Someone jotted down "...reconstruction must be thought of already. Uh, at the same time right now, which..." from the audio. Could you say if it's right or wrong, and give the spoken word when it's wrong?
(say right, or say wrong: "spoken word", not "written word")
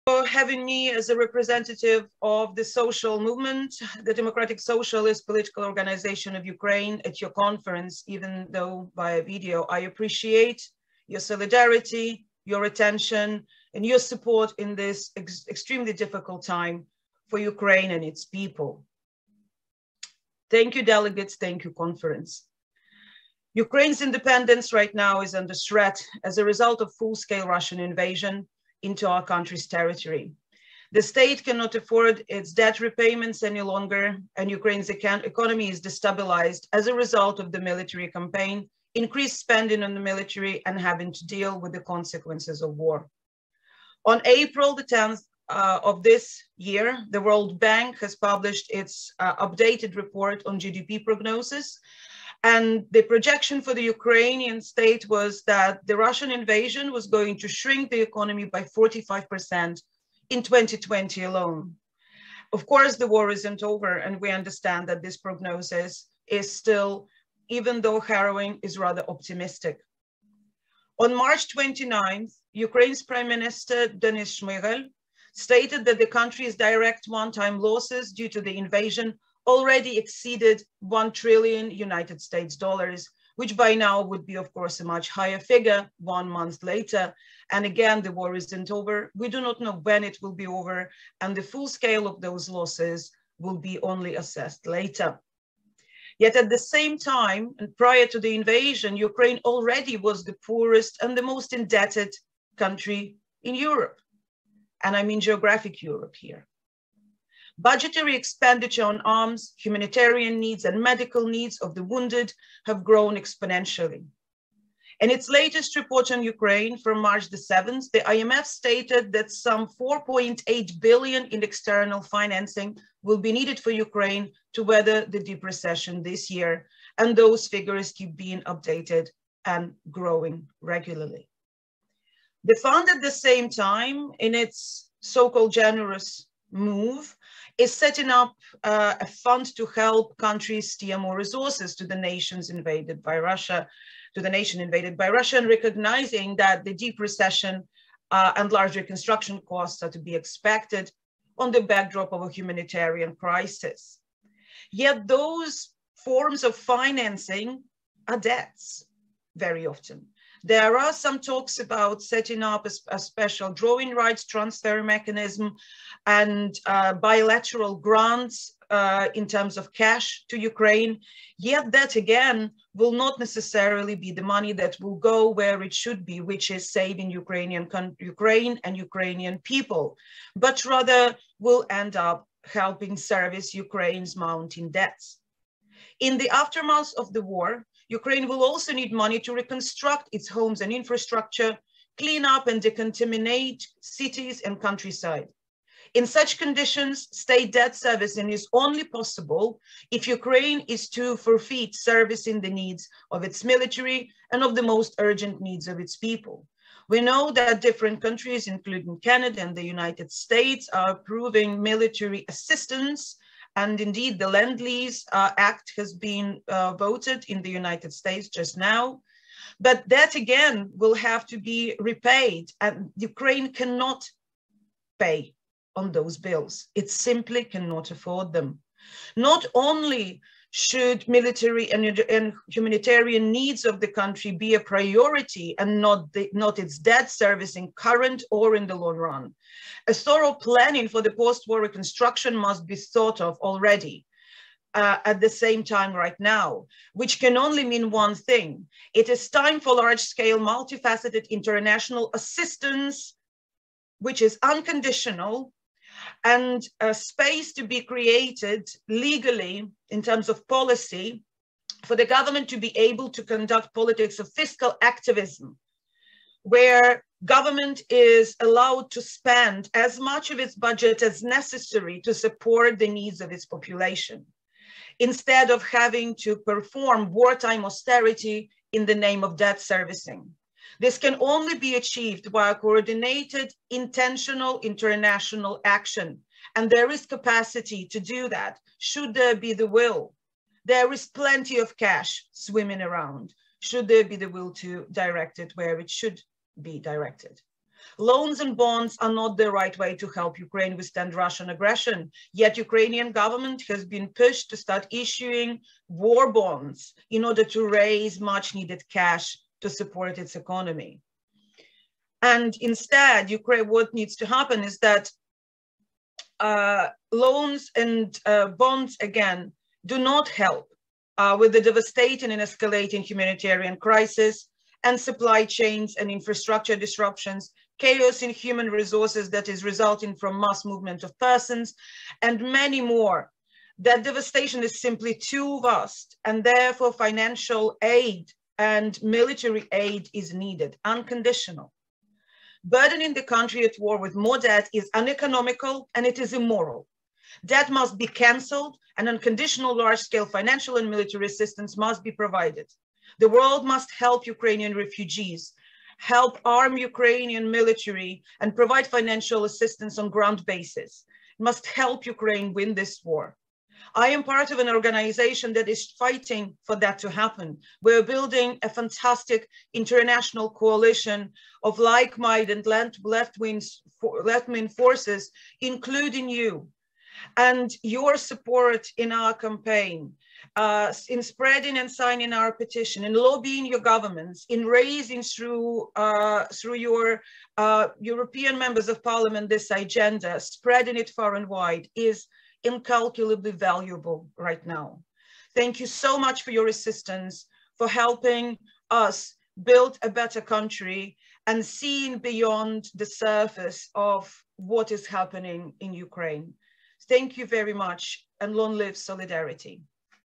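right.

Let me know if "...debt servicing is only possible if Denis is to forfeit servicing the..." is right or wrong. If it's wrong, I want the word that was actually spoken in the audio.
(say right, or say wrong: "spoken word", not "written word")
wrong: "Ukraine", not "Denis".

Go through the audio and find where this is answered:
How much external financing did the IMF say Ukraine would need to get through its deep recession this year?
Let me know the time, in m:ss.
1:59.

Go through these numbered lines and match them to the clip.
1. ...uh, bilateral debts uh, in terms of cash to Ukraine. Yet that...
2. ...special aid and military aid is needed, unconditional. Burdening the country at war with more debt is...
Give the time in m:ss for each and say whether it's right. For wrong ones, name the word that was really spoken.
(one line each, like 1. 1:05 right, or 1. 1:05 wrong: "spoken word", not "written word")
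1. 2:46 wrong: "grants", not "debts"
2. 5:36 wrong: "financial", not "special".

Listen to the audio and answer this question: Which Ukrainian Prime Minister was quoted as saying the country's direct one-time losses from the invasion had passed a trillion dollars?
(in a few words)
Denis Shmyhal.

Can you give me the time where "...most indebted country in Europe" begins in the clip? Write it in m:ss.
1:41.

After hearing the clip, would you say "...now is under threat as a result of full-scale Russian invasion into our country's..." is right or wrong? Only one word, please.
right.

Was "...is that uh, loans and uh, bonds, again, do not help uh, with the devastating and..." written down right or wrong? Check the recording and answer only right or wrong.
right.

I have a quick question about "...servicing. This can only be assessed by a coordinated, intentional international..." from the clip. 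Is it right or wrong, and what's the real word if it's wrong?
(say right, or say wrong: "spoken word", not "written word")
wrong: "achieved", not "assessed".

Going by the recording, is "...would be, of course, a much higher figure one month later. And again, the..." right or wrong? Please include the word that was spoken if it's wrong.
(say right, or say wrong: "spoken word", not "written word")
right.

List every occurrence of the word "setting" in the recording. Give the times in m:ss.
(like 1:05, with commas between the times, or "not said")
2:17, 2:42.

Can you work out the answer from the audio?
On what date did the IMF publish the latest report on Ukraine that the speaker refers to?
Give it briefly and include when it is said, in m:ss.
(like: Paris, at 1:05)
March 7, at 1:57.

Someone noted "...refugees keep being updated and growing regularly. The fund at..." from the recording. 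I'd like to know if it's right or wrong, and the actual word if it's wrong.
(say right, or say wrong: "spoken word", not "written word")
wrong: "figures", not "refugees".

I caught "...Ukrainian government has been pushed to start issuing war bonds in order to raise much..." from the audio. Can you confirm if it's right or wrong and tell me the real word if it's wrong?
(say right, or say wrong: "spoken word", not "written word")
right.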